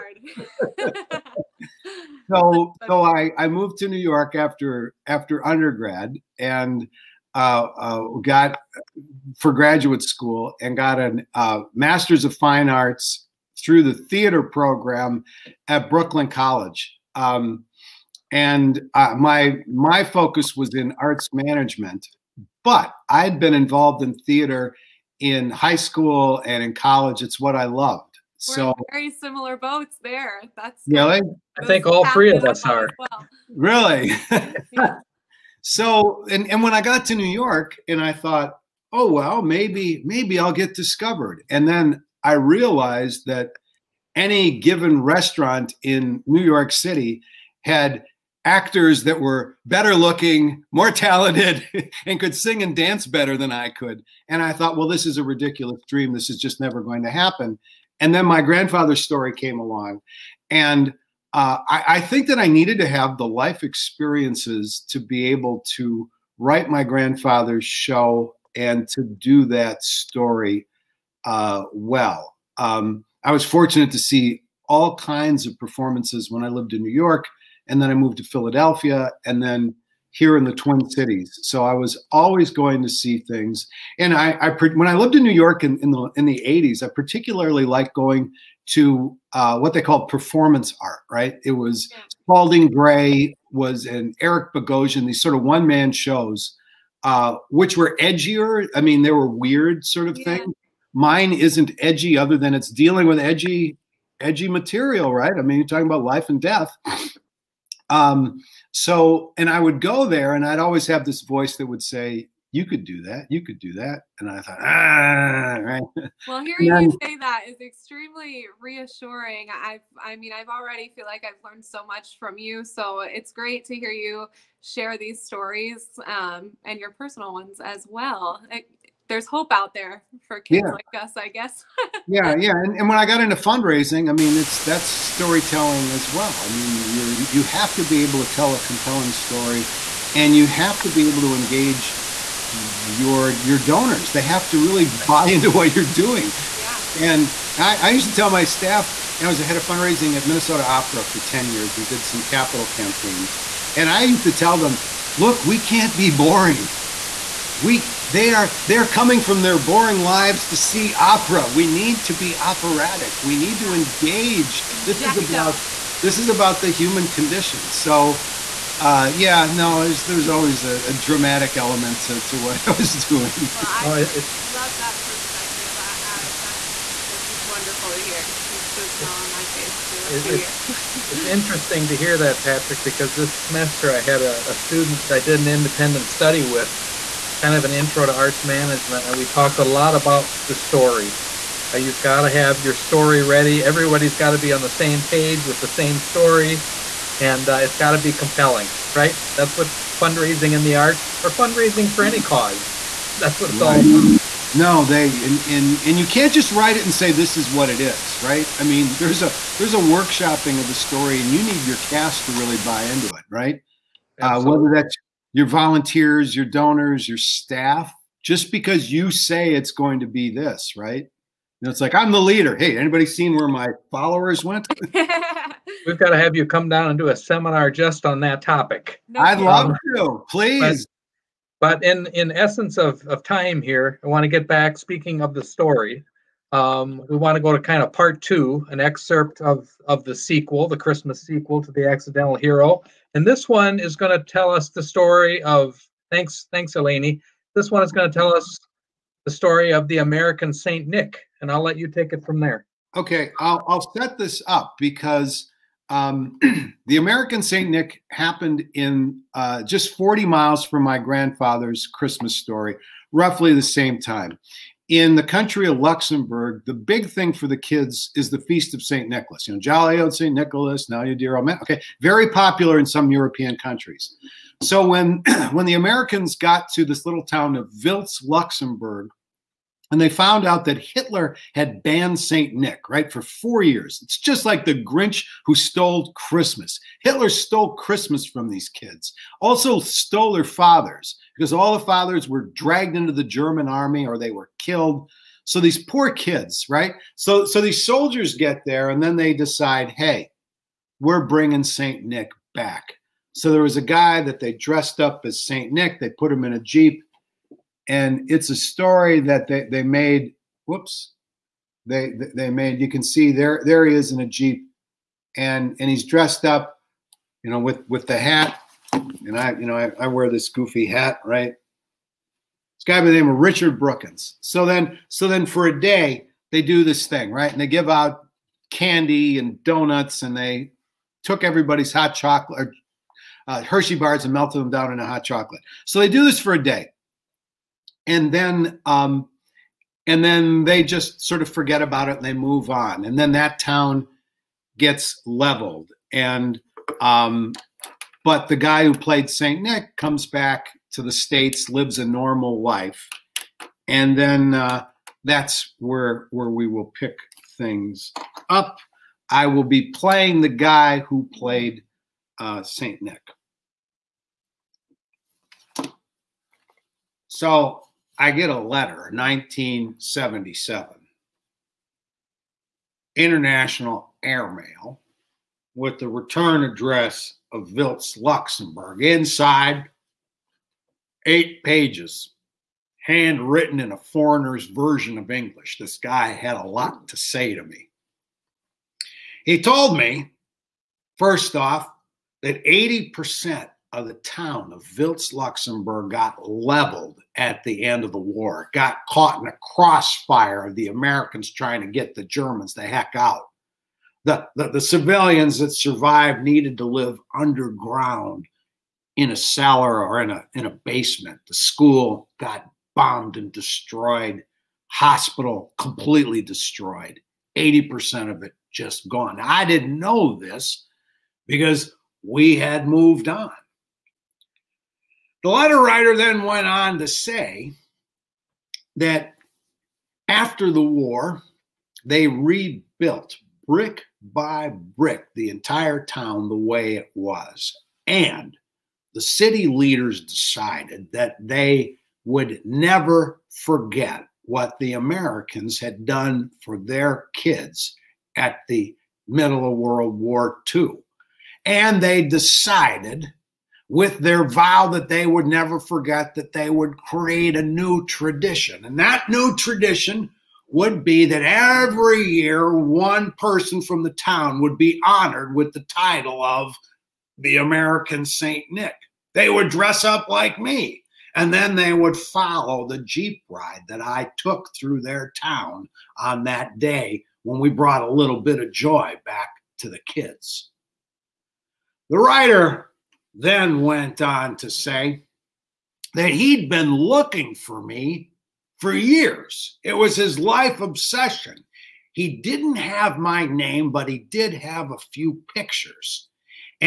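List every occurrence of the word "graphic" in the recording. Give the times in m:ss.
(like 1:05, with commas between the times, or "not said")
not said.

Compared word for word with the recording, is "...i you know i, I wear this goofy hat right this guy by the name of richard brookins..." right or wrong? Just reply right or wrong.
right.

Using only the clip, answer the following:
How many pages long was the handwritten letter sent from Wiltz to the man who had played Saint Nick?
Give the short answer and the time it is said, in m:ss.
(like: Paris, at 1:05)
8, at 6:21.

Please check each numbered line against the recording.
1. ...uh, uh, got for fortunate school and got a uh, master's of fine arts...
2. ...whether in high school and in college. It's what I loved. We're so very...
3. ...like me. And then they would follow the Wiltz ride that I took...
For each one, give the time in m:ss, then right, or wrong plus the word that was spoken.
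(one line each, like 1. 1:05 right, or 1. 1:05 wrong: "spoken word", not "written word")
1. 0:07 wrong: "graduate", not "fortunate"
2. 0:24 wrong: "theater", not "whether"
3. 7:50 wrong: "Jeep", not "Wiltz".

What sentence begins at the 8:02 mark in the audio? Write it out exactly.
The writer then went on to say that he'd been looking for me for years.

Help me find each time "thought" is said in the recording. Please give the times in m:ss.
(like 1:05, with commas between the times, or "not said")
0:38, 0:54, 1:54.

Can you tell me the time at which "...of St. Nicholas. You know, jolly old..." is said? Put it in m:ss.
4:28.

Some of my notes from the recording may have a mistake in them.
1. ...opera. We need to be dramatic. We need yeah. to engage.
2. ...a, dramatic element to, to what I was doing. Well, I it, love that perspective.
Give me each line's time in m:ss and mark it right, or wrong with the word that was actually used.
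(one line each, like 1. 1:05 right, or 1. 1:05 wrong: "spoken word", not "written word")
1. 2:40 wrong: "operatic", not "dramatic"
2. 2:50 right.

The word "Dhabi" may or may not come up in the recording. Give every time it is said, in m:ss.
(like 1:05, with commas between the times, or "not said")
not said.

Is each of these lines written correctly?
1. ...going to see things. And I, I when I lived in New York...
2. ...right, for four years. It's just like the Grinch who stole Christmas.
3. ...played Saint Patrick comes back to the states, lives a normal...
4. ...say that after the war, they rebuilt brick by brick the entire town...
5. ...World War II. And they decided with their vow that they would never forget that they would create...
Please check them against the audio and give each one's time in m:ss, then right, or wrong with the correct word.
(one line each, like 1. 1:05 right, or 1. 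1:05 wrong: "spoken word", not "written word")
1. 1:22 right
2. 4:42 right
3. 5:48 wrong: "Nick", not "Patrick"
4. 7:07 right
5. 7:29 right.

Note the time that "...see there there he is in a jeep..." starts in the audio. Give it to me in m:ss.
5:13.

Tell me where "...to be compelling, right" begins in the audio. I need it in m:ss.
3:17.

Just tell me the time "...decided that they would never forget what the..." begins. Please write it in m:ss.
7:20.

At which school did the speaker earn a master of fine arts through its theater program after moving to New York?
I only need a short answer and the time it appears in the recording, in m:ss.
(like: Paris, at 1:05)
Brooklyn College, at 0:15.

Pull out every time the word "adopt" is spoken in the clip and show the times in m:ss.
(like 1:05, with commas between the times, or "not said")
not said.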